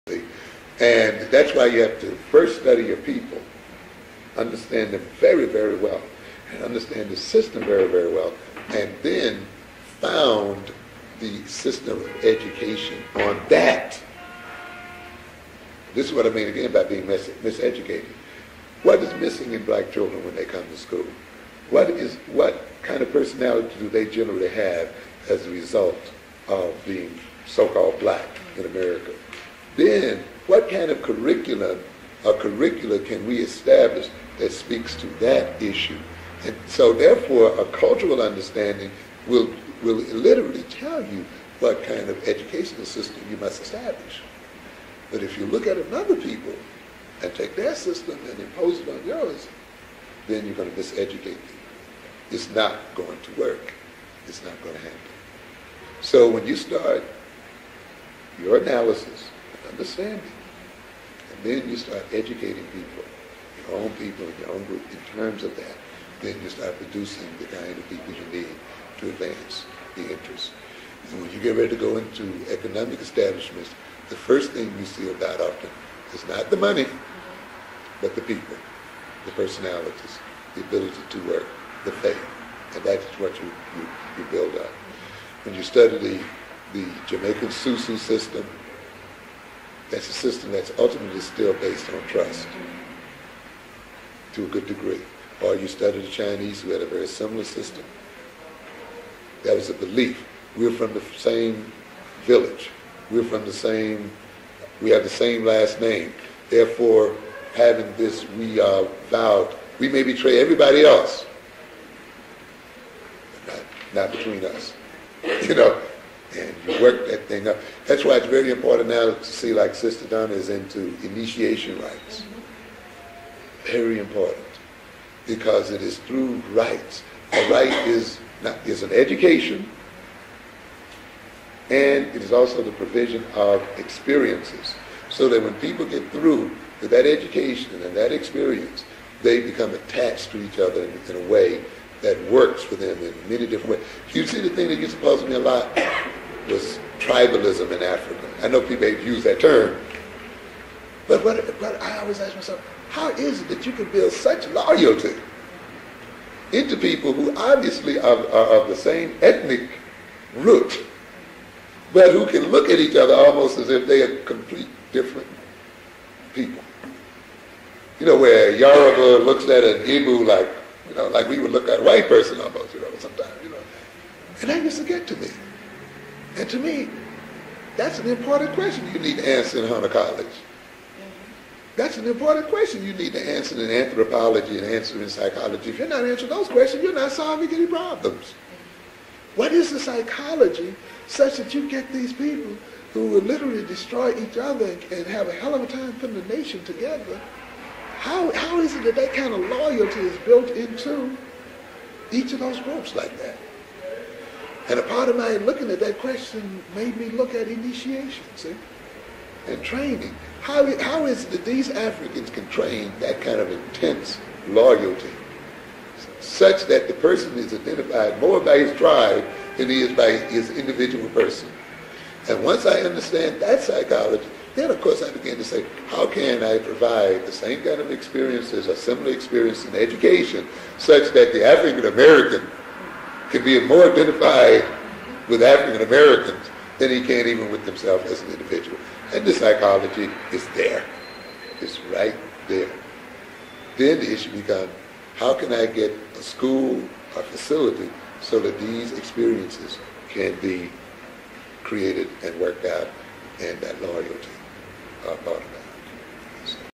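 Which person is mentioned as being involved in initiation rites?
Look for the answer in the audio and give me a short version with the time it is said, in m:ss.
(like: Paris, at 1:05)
Sister Donna, at 1:59.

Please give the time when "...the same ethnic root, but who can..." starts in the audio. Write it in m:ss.
2:38.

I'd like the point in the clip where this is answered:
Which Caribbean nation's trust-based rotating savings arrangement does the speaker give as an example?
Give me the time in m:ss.
1:27.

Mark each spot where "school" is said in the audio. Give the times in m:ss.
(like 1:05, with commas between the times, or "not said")
0:20, 4:06.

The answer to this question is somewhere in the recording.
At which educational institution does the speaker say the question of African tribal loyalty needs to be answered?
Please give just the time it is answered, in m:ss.
2:59.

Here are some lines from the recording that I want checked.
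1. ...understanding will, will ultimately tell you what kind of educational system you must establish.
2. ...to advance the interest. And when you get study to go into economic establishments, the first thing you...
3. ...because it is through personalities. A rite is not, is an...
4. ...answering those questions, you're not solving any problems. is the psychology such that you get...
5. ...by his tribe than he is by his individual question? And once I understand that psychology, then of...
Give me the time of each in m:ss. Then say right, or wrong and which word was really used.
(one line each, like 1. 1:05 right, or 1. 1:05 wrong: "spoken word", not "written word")
1. 0:38 wrong: "literally", not "ultimately"
2. 1:08 wrong: "ready", not "study"
3. 2:05 wrong: "rites", not "personalities"
4. 3:06 right
5. 3:38 wrong: "person", not "question".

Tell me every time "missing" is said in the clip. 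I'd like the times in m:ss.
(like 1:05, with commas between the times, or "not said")
0:19.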